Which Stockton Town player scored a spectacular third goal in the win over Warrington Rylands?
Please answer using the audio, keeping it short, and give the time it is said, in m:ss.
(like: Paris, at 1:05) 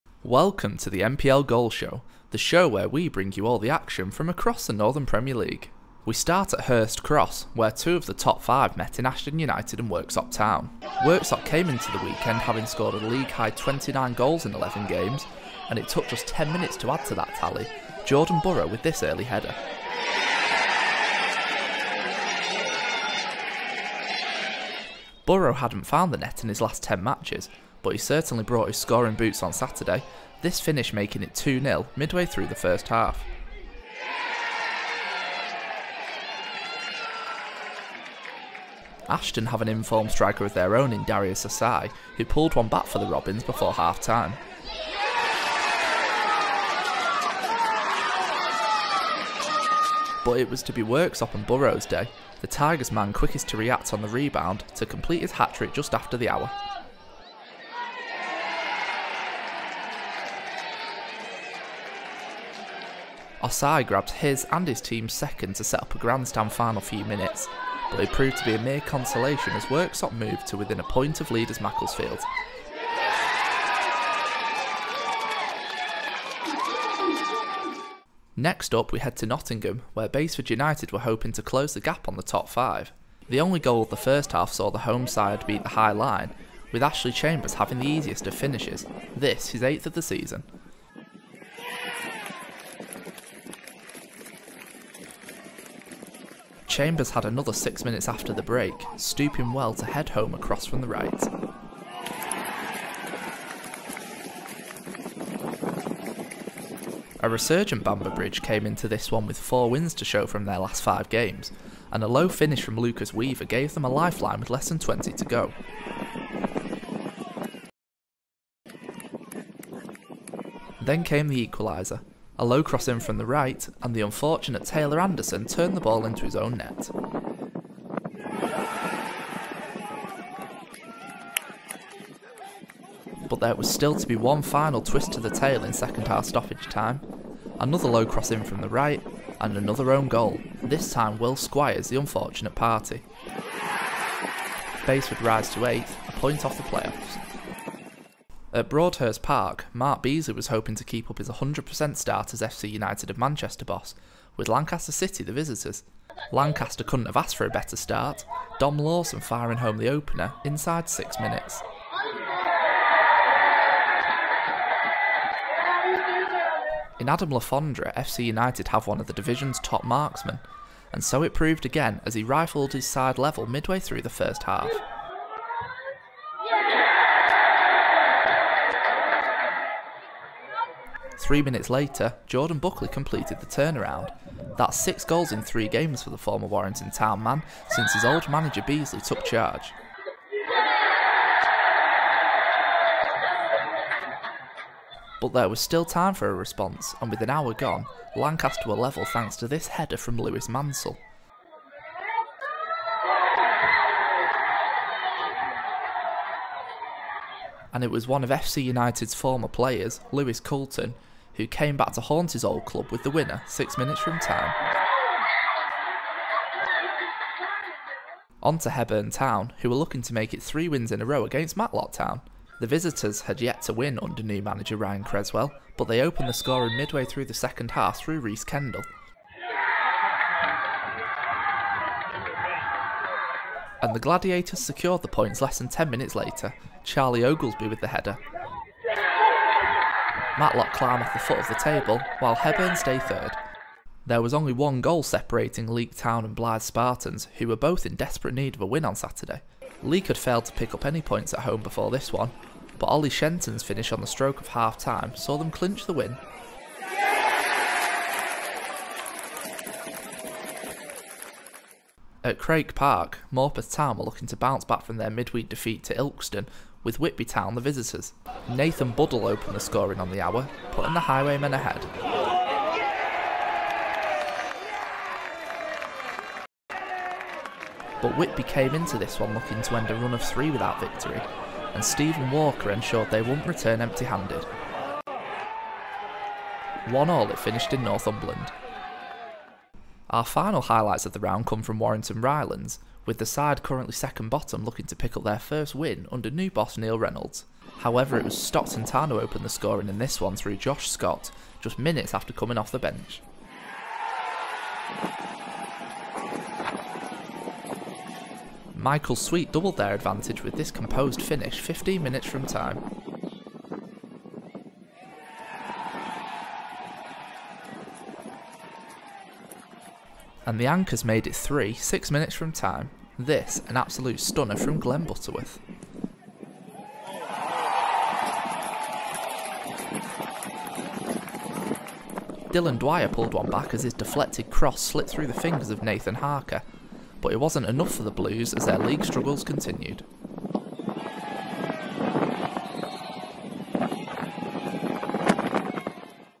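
Glenn Butterworth, at 5:24.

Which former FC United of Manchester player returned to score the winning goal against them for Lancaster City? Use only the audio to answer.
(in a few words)
Lewis Coulton.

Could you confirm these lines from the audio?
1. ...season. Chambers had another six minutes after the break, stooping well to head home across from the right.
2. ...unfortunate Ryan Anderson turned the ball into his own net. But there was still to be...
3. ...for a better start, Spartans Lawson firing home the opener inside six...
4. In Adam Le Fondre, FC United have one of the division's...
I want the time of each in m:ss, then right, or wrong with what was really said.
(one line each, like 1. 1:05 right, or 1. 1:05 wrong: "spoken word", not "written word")
1. 1:30 right
2. 2:04 wrong: "Taylor", not "Ryan"
3. 2:37 wrong: "Dom", not "Spartans"
4. 2:46 right.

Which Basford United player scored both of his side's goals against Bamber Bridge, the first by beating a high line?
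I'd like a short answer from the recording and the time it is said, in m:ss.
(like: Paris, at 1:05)
Ashley Chambers, at 1:26.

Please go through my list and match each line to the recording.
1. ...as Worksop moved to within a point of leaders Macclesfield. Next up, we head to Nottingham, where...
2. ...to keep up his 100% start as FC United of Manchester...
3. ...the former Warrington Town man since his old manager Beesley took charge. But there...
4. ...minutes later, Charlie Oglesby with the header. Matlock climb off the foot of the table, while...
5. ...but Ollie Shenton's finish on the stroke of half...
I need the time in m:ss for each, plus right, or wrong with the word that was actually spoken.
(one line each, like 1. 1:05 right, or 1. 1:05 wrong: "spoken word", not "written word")
1. 1:09 right
2. 2:30 right
3. 3:06 right
4. 3:55 right
5. 4:12 right.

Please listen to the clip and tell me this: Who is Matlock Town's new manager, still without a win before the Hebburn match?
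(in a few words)
Ryan Cresswell.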